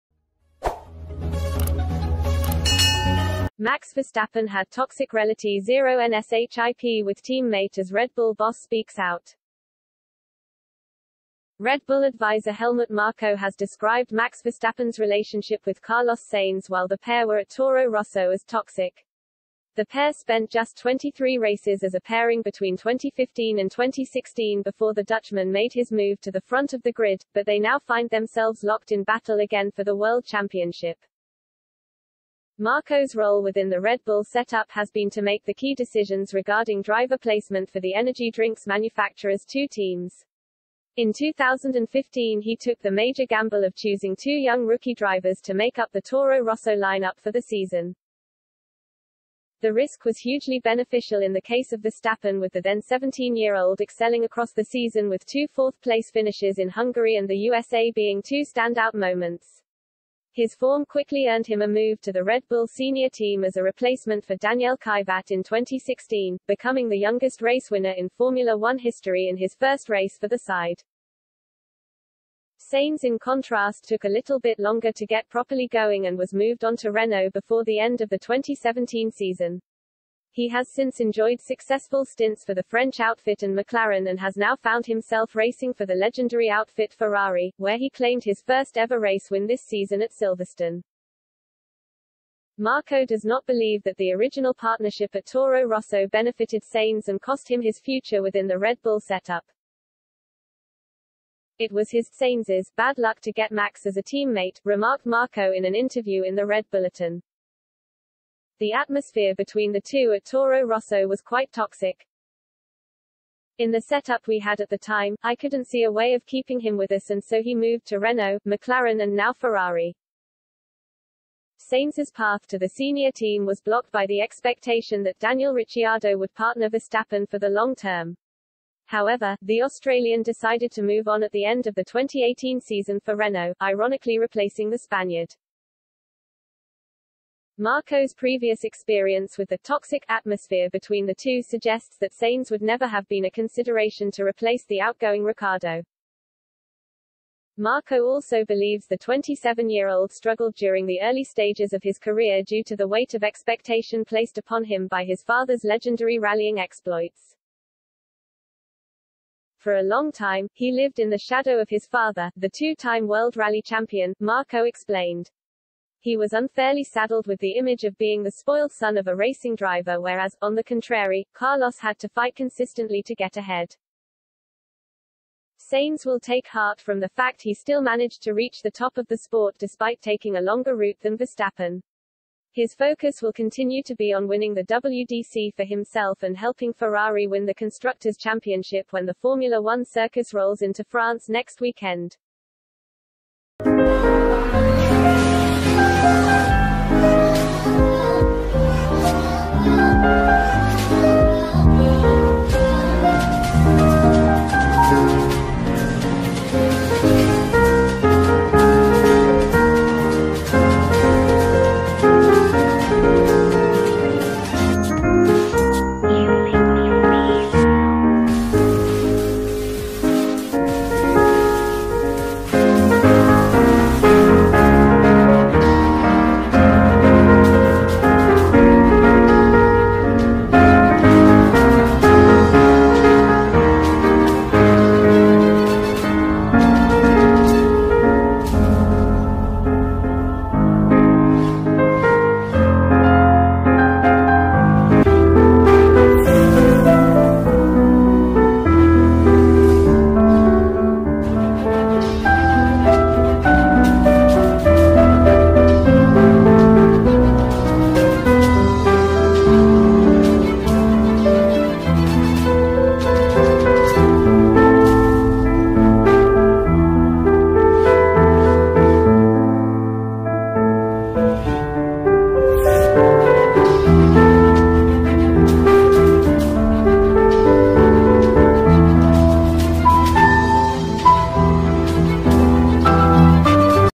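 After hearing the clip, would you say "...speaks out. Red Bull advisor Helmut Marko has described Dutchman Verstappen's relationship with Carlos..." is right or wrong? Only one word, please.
wrong.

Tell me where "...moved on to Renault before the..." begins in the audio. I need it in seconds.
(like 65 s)
76 s.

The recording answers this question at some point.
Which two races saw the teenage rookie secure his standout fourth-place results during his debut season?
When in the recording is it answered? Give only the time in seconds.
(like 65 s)
56 s.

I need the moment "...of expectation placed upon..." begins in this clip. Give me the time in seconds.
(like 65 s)
153 s.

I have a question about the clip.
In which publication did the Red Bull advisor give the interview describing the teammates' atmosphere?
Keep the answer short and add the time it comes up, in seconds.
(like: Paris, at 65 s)
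The Red Bulletin, at 106 s.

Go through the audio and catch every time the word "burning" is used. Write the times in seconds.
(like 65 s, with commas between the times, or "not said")
not said.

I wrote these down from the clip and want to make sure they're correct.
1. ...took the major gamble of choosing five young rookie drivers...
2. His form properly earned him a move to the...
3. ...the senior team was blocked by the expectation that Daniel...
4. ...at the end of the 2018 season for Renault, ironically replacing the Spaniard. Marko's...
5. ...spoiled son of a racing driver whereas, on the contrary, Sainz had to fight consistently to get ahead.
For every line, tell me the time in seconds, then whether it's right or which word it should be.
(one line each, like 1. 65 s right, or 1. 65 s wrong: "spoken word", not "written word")
1. 42 s wrong: "two", not "five"
2. 60 s wrong: "quickly", not "properly"
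3. 122 s right
4. 131 s right
5. 168 s wrong: "Carlos", not "Sainz".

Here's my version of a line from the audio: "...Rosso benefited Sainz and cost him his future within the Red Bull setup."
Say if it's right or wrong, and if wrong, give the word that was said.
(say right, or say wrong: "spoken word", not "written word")
right.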